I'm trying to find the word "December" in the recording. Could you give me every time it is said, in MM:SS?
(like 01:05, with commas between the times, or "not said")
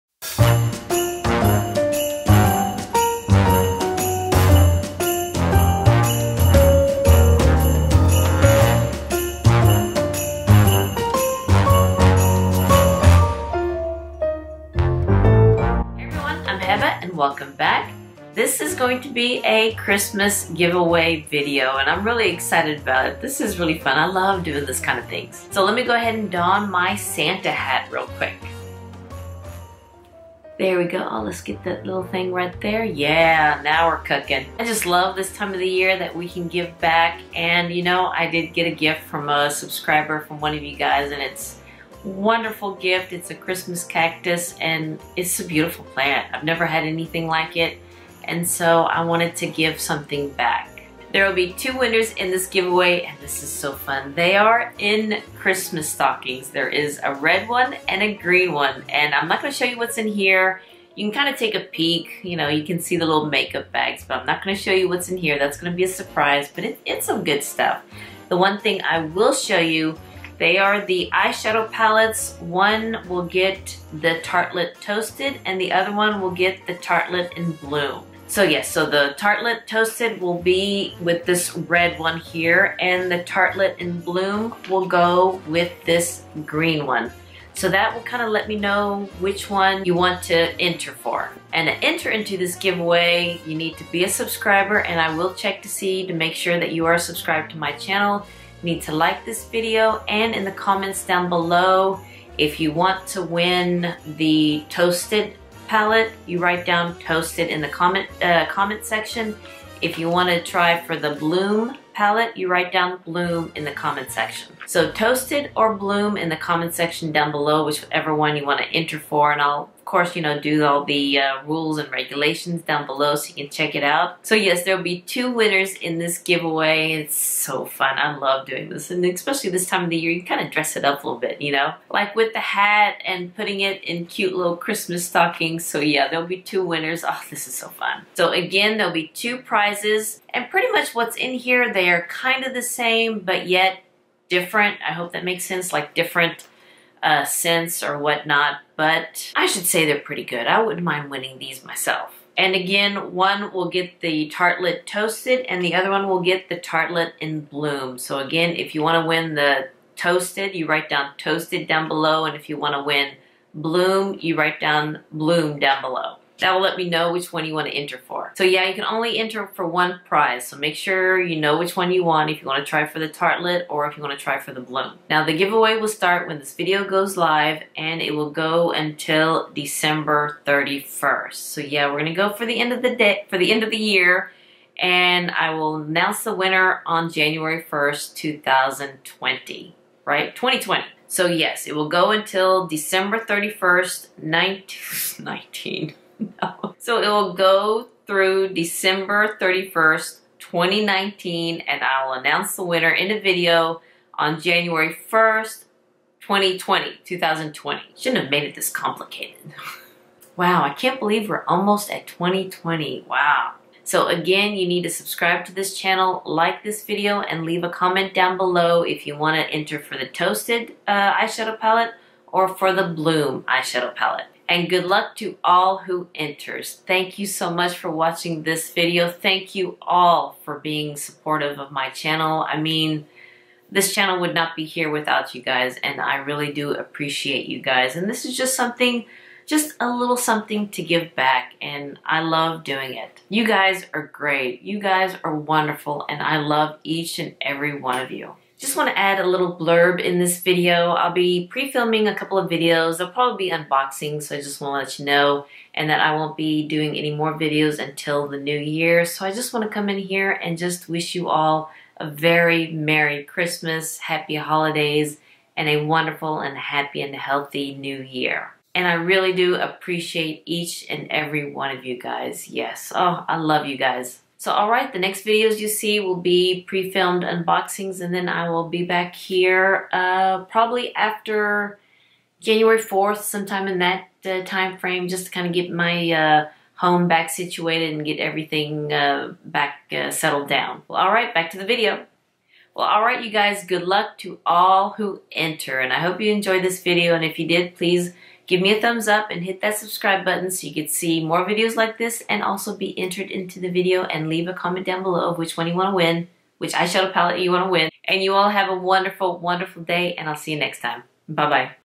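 02:59, 03:12, 03:18.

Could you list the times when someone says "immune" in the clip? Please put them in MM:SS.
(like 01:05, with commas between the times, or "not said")
not said.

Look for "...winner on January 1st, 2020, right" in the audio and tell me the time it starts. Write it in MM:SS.
03:06.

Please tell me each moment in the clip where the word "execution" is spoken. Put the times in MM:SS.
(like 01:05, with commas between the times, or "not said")
not said.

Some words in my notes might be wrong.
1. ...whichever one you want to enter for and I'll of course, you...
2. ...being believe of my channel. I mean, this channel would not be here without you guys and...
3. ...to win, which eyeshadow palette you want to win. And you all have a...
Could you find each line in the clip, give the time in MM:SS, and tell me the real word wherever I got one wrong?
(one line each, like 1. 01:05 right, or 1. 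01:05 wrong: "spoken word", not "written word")
1. 01:57 right
2. 03:50 wrong: "supportive", not "believe"
3. 05:05 right.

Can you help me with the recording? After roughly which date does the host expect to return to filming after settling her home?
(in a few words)
January 4th.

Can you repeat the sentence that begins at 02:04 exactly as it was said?
So yes, there'll be two winners in this giveaway.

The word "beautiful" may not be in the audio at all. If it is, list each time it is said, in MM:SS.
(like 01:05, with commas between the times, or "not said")
00:45.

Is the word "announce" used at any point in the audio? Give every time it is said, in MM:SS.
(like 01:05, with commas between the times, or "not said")
03:05, 03:22.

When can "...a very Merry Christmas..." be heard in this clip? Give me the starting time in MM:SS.
04:21.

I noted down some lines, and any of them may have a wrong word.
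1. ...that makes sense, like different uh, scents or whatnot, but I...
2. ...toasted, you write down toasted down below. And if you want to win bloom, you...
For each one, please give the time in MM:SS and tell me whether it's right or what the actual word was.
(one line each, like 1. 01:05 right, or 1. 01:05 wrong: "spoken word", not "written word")
1. 02:25 right
2. 02:39 right.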